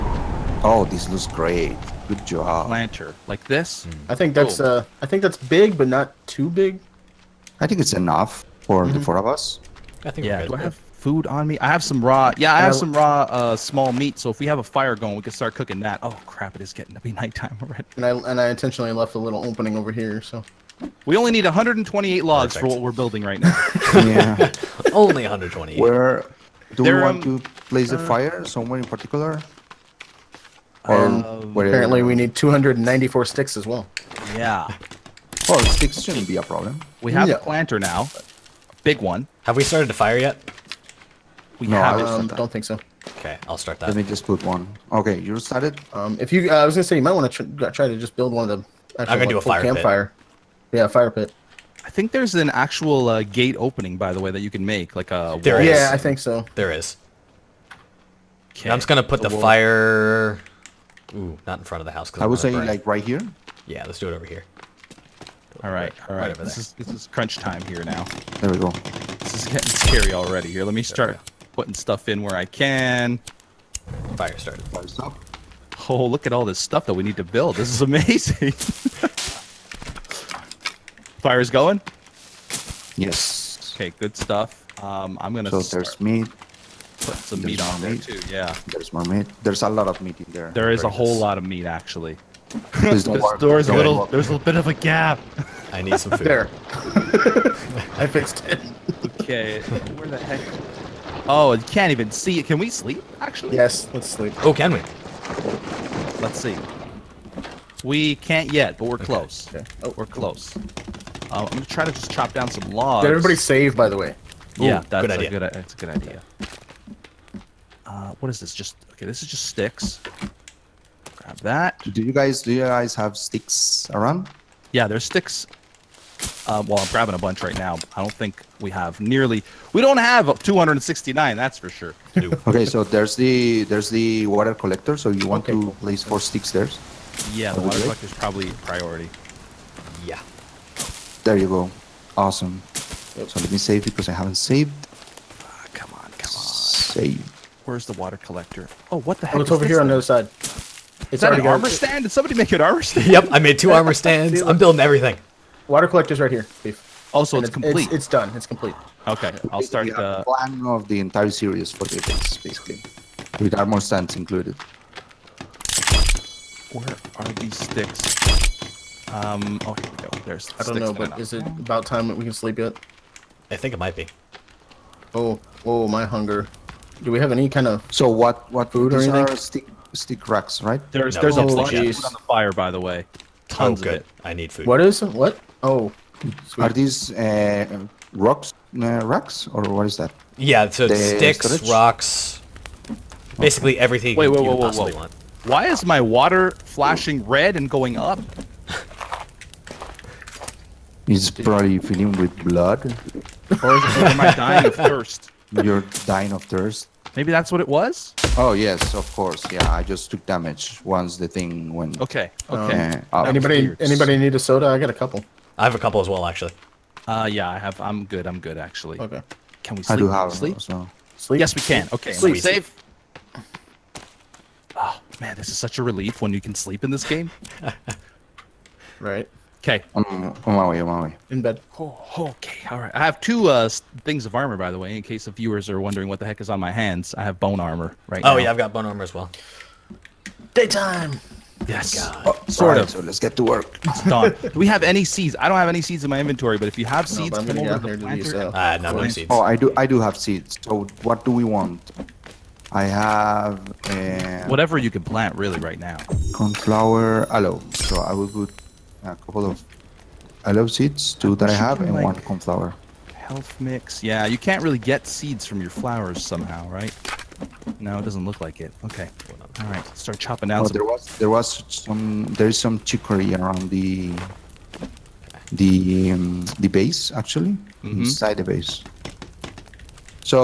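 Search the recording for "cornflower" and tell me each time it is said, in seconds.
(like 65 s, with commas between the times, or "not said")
256 s, 262 s.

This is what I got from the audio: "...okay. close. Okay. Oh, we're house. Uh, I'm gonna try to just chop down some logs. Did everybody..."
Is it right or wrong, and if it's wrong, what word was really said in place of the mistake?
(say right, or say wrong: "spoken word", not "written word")
wrong: "close", not "house".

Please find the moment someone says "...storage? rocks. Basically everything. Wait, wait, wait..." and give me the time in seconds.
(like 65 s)
191 s.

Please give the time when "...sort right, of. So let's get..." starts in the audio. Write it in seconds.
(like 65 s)
242 s.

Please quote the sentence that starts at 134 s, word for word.
So you want okay, to cool.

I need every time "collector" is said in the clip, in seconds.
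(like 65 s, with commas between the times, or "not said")
134 s, 148 s, 155 s.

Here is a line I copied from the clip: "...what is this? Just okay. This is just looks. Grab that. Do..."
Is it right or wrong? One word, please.
wrong.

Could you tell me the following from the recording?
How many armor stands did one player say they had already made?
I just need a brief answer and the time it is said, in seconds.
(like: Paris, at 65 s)
2, at 153 s.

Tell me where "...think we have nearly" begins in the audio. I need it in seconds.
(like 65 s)
128 s.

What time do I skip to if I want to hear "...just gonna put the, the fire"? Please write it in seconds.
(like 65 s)
58 s.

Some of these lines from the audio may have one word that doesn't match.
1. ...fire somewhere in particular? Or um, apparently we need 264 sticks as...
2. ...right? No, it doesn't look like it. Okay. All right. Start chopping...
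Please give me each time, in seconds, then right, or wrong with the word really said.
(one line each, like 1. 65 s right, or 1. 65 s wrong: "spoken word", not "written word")
1. 28 s wrong: "294", not "264"
2. 266 s right.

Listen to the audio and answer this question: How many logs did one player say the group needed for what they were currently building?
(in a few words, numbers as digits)
128.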